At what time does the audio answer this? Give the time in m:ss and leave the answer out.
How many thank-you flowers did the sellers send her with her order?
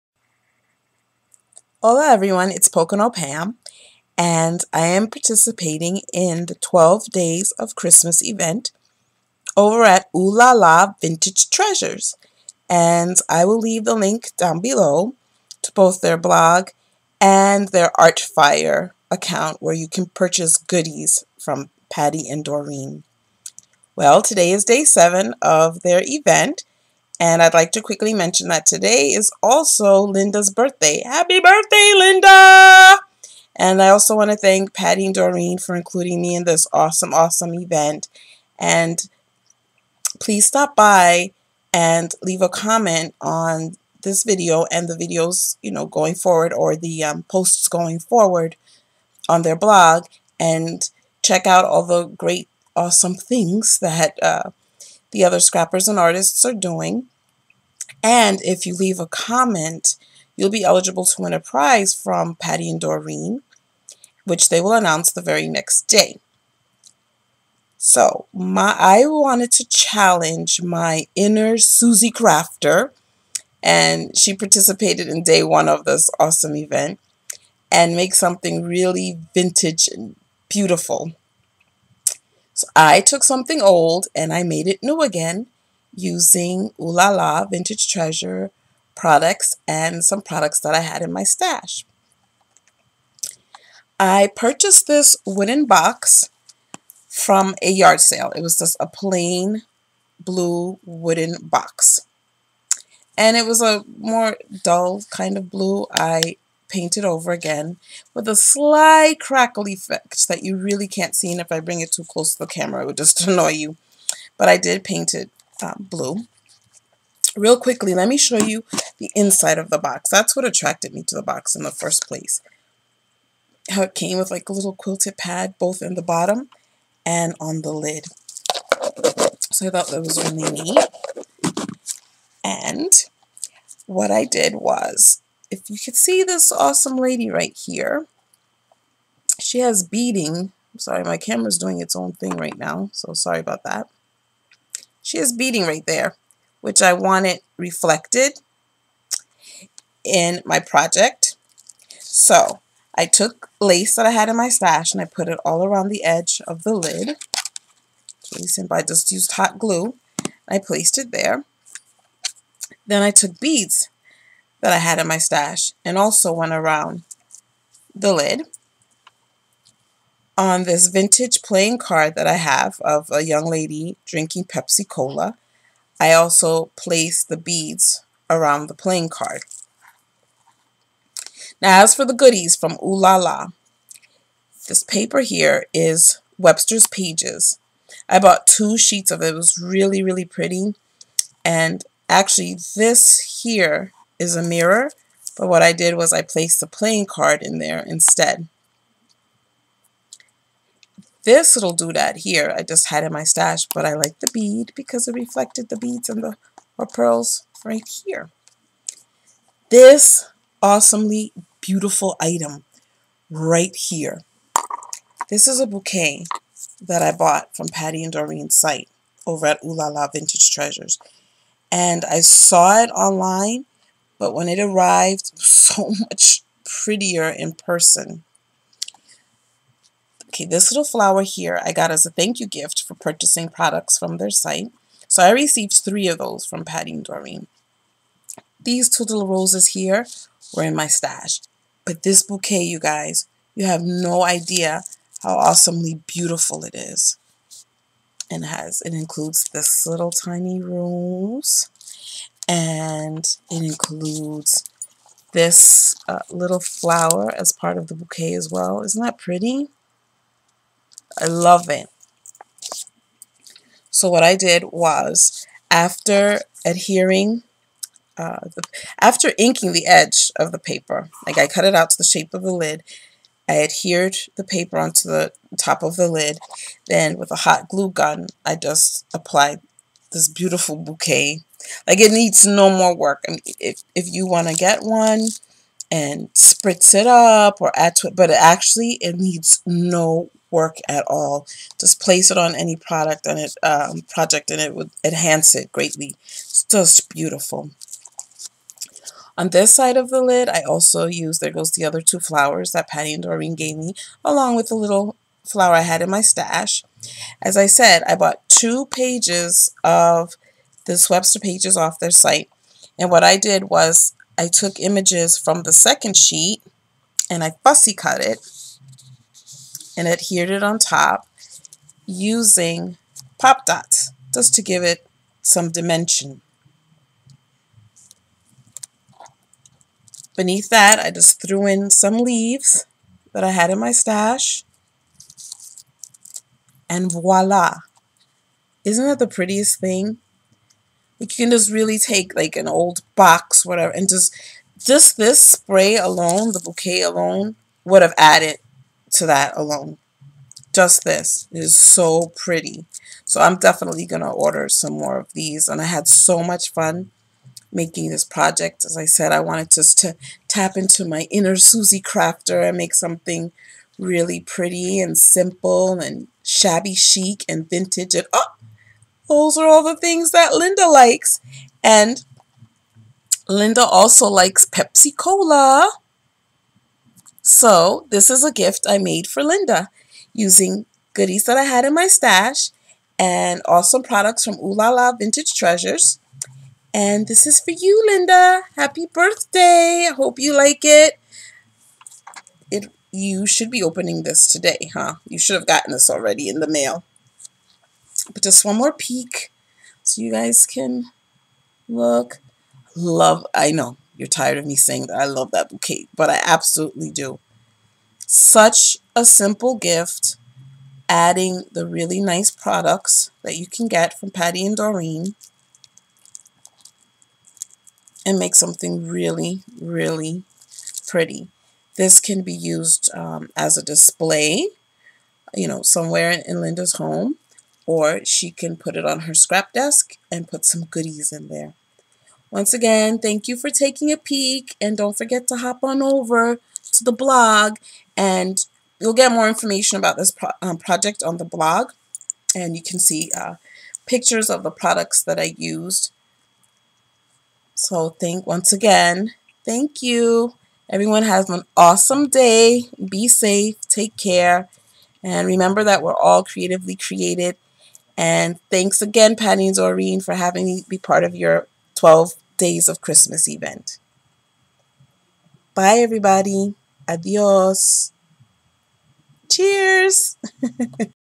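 3:55.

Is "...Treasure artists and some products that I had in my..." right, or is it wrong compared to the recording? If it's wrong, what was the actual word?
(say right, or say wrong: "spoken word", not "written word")
wrong: "products", not "artists".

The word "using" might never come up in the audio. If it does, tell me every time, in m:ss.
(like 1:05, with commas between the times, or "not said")
1:25, 5:22, 6:20.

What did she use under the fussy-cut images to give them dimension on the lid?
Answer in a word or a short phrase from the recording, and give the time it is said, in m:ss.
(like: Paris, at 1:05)
Pop dots, at 5:23.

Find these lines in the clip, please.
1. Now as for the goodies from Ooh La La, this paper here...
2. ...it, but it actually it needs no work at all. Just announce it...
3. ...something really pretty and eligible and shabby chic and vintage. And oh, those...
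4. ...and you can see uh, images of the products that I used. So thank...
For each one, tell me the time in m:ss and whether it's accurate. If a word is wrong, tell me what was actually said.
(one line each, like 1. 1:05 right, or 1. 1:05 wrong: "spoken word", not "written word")
1. 3:01 right
2. 4:48 wrong: "place", not "announce"
3. 6:02 wrong: "simple", not "eligible"
4. 7:22 wrong: "pictures", not "images".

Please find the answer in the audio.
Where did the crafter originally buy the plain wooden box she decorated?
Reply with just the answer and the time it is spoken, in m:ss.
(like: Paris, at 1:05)
A yard sale, at 1:37.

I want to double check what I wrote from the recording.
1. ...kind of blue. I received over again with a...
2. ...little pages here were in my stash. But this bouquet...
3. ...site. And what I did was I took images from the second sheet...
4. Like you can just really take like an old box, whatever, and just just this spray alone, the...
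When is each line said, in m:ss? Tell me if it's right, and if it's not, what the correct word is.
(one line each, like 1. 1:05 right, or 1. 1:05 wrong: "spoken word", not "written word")
1. 1:45 wrong: "painted", not "received"
2. 3:59 wrong: "roses", not "pages"
3. 5:12 right
4. 5:41 right.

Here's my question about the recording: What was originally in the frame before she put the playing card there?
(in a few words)
A mirror.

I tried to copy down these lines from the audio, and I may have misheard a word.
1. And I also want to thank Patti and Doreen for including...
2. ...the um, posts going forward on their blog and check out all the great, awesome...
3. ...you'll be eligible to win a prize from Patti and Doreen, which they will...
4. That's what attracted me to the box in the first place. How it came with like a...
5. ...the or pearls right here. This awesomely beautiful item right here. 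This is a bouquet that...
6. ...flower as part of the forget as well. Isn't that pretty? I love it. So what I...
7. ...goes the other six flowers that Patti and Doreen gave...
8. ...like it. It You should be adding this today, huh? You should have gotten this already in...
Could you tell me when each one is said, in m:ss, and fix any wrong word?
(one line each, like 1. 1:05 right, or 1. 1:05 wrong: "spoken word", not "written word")
1. 0:33 right
2. 0:46 right
3. 1:00 right
4. 2:00 right
5. 3:26 right
6. 4:16 wrong: "bouquet", not "forget"
7. 5:01 wrong: "two", not "six"
8. 6:30 wrong: "opening", not "adding".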